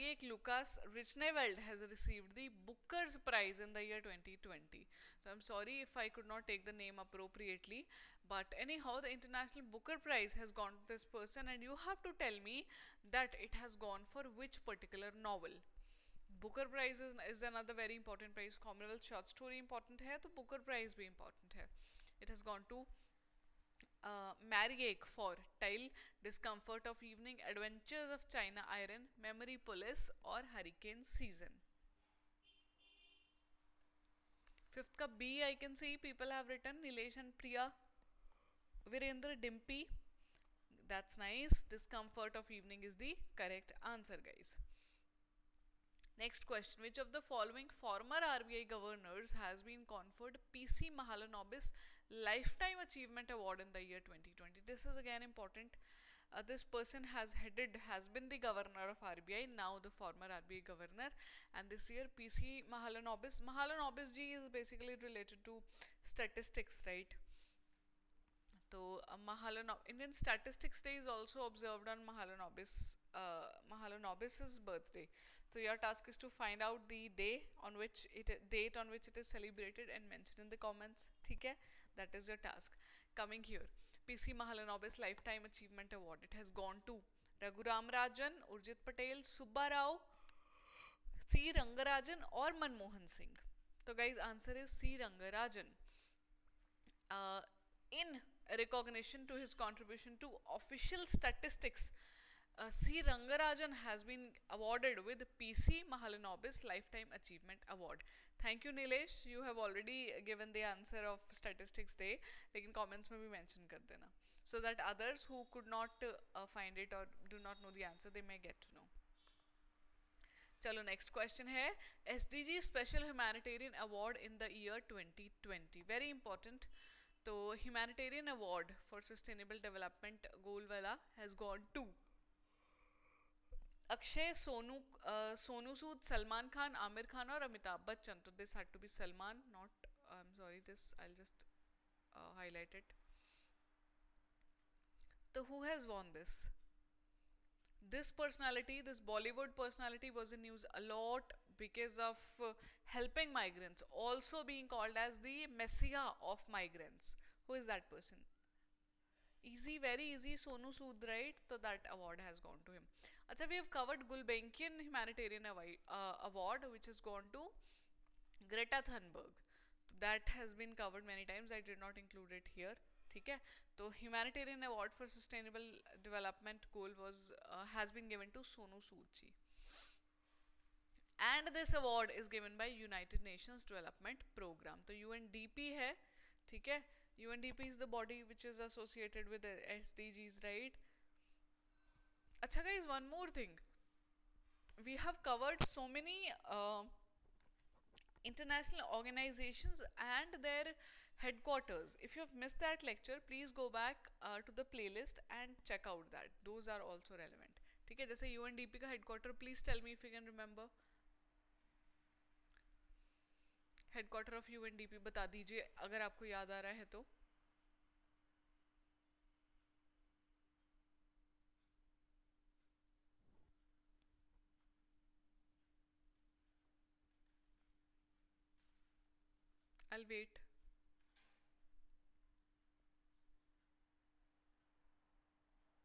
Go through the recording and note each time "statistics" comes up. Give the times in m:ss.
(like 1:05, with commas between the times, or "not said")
1:06, 1:10, 1:41, 1:51.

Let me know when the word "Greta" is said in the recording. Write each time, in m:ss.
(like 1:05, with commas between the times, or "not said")
2:48.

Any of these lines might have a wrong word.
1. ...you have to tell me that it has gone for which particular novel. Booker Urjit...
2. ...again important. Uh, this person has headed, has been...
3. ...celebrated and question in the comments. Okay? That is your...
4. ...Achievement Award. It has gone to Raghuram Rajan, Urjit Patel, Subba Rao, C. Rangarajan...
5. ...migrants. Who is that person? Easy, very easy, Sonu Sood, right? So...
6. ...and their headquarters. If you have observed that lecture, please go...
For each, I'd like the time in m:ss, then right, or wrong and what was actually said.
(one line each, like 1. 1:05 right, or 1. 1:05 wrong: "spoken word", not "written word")
1. 0:11 wrong: "Prize", not "Urjit"
2. 0:54 right
3. 1:19 wrong: "mention", not "question"
4. 1:25 right
5. 2:36 right
6. 3:19 wrong: "missed", not "observed".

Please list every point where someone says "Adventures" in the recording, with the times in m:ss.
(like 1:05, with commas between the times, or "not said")
0:27.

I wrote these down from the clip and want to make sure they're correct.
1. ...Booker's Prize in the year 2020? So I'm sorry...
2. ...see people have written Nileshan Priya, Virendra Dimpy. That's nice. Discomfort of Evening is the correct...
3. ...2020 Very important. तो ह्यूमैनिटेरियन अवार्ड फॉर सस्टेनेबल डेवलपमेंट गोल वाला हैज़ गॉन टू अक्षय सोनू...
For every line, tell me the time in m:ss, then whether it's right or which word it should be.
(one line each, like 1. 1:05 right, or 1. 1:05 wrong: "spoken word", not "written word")
1. 0:02 right
2. 0:35 right
3. 2:04 right.